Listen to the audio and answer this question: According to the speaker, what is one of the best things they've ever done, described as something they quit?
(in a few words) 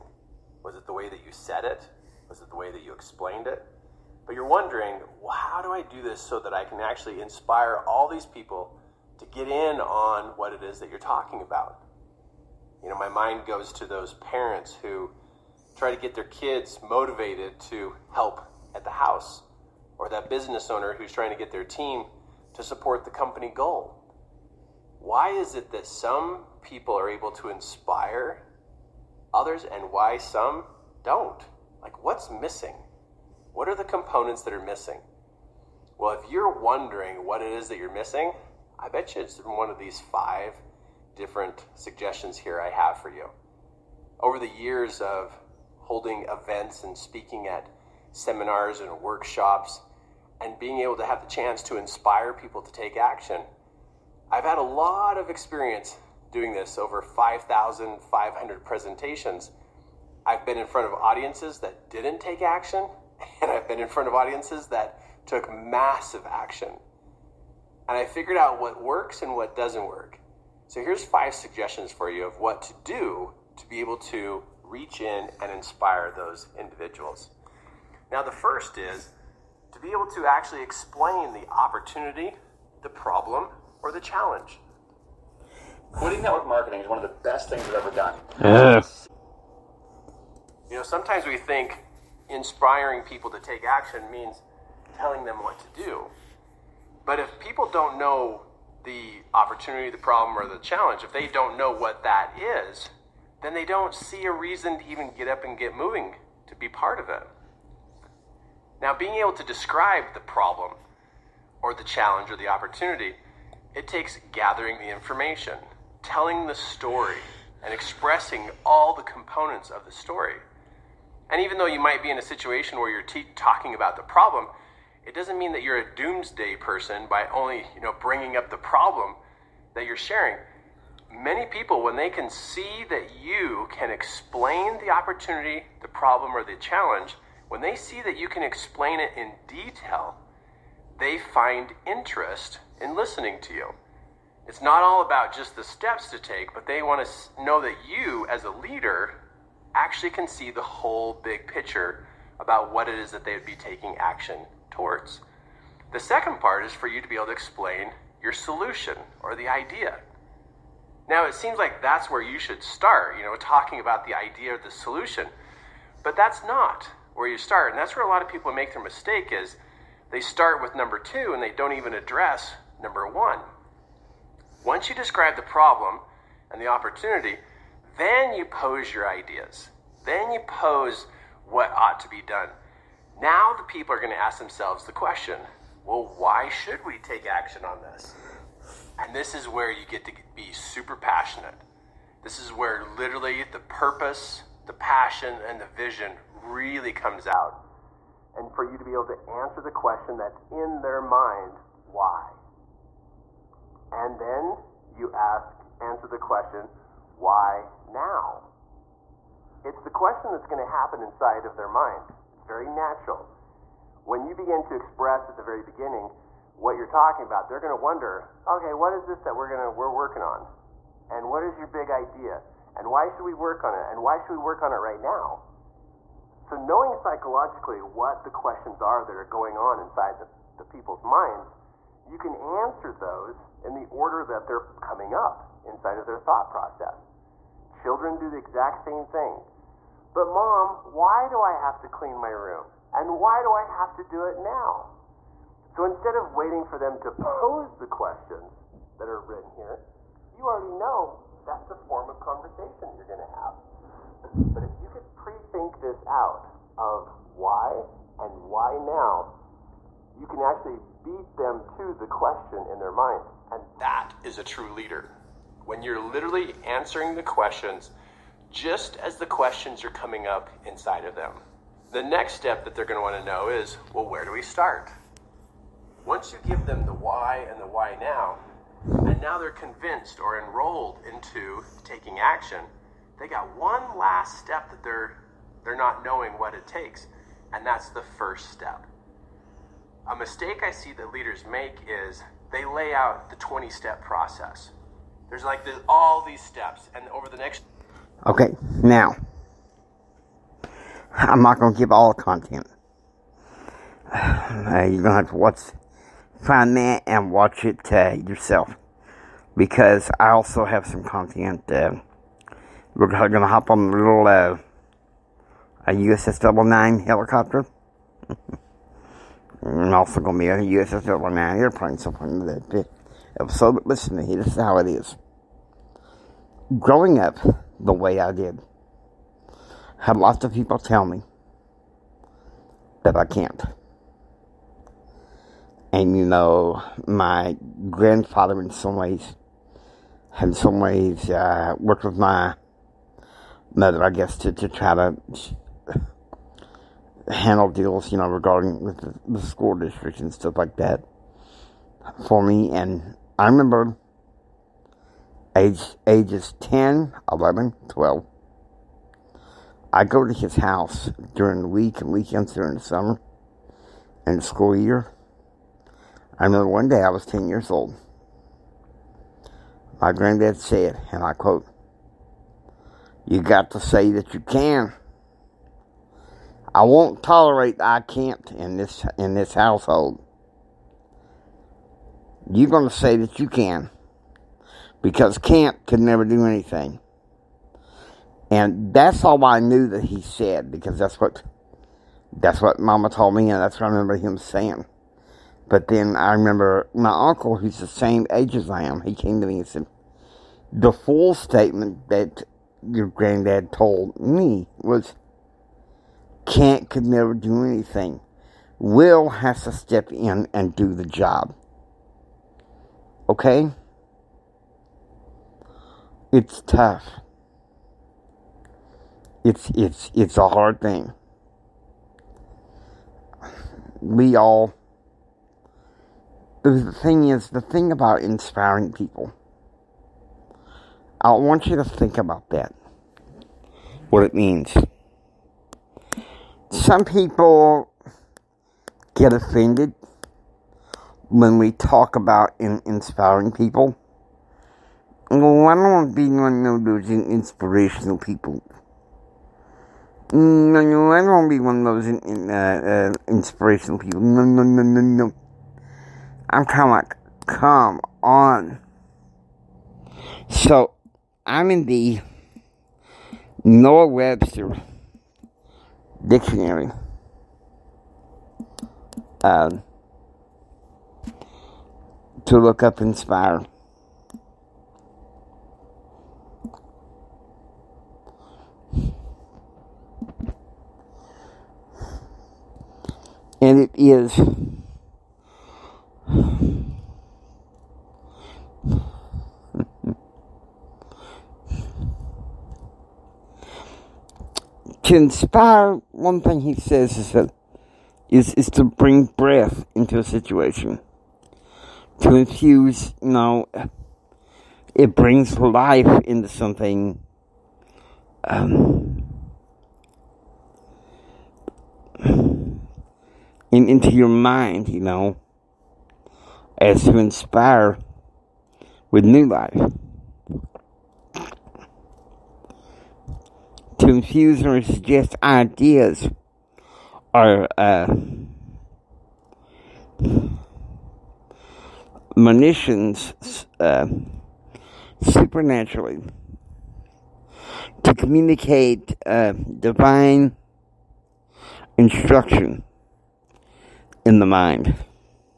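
network marketing.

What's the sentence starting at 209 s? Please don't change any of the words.
It's the question that's going to happen inside of their mind.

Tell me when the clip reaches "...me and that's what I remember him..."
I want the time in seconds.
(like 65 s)
393 s.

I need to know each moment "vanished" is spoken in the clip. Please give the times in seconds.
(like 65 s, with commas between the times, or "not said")
not said.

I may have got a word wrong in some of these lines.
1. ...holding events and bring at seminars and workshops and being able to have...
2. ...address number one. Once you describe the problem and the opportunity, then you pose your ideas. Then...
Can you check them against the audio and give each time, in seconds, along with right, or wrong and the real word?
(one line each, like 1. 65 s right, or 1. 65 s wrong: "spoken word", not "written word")
1. 45 s wrong: "speaking", not "bring"
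2. 171 s right.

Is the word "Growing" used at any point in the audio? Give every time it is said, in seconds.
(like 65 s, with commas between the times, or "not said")
326 s.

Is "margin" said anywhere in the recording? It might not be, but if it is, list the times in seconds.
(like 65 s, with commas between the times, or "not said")
not said.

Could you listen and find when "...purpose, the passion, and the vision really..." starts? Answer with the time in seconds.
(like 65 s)
193 s.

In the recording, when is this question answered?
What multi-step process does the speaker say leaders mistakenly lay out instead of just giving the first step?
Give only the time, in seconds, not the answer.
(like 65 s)
293 s.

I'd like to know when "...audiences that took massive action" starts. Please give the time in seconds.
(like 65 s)
64 s.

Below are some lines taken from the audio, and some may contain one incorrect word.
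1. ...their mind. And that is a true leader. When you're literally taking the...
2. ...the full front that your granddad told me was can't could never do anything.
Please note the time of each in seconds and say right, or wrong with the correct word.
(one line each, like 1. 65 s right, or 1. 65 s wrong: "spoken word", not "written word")
1. 262 s wrong: "answering", not "taking"
2. 400 s wrong: "statement", not "front".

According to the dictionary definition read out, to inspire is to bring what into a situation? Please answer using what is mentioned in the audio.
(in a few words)
breath.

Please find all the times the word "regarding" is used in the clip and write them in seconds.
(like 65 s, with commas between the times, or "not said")
348 s.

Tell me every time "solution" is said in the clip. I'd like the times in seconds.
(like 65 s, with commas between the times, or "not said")
158 s, 164 s.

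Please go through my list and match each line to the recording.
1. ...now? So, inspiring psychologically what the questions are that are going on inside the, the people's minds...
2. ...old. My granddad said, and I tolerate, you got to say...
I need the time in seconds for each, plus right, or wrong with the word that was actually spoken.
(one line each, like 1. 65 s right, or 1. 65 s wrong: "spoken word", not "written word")
1. 225 s wrong: "knowing", not "inspiring"
2. 367 s wrong: "quote", not "tolerate".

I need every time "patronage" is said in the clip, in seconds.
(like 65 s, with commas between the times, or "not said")
not said.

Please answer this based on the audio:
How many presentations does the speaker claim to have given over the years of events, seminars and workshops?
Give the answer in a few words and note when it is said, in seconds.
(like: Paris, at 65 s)
over 5,500, at 56 s.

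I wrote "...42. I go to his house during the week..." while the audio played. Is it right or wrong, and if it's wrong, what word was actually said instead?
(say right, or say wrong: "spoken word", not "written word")
wrong: "12", not "42".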